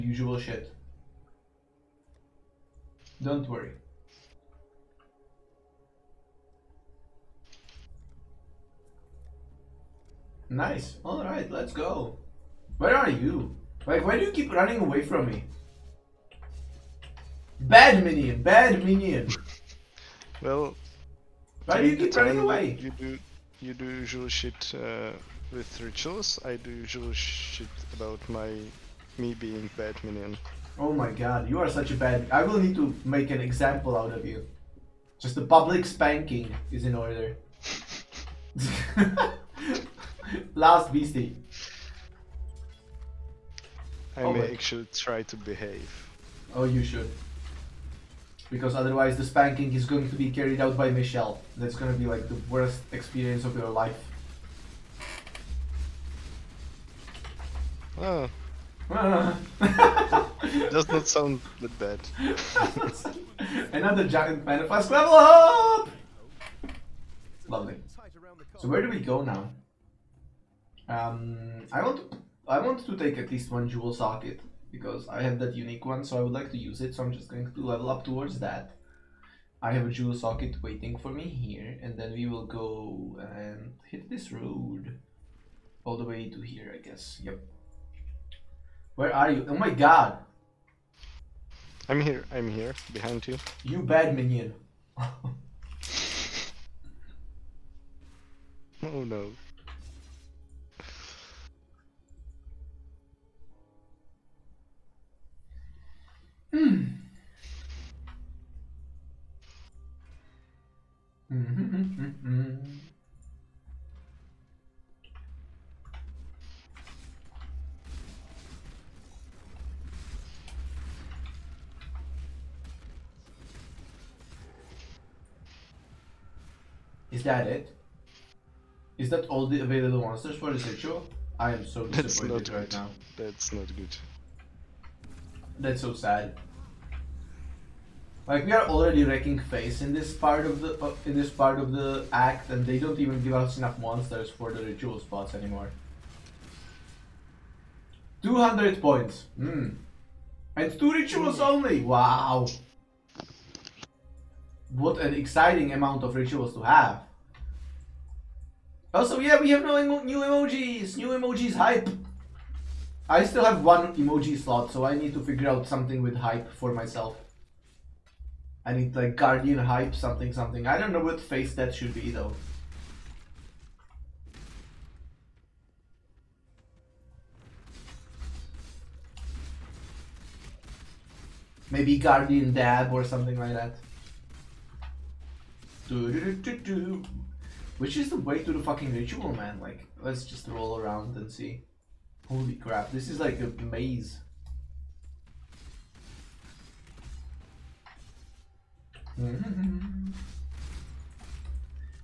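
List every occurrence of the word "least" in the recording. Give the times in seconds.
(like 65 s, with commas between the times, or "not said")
73 s.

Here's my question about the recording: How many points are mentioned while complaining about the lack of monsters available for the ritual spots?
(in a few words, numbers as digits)
200.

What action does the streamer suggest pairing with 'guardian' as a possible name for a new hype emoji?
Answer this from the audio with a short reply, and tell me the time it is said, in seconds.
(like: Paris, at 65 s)
dab, at 182 s.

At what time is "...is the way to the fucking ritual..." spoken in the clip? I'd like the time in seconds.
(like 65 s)
187 s.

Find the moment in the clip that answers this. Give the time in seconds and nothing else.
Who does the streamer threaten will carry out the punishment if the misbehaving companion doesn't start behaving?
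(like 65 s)
50 s.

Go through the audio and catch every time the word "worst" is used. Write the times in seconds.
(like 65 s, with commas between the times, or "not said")
52 s.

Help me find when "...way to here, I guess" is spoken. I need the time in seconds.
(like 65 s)
86 s.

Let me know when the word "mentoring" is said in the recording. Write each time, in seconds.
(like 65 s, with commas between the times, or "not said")
not said.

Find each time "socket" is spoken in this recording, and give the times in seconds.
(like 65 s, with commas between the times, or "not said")
73 s, 80 s.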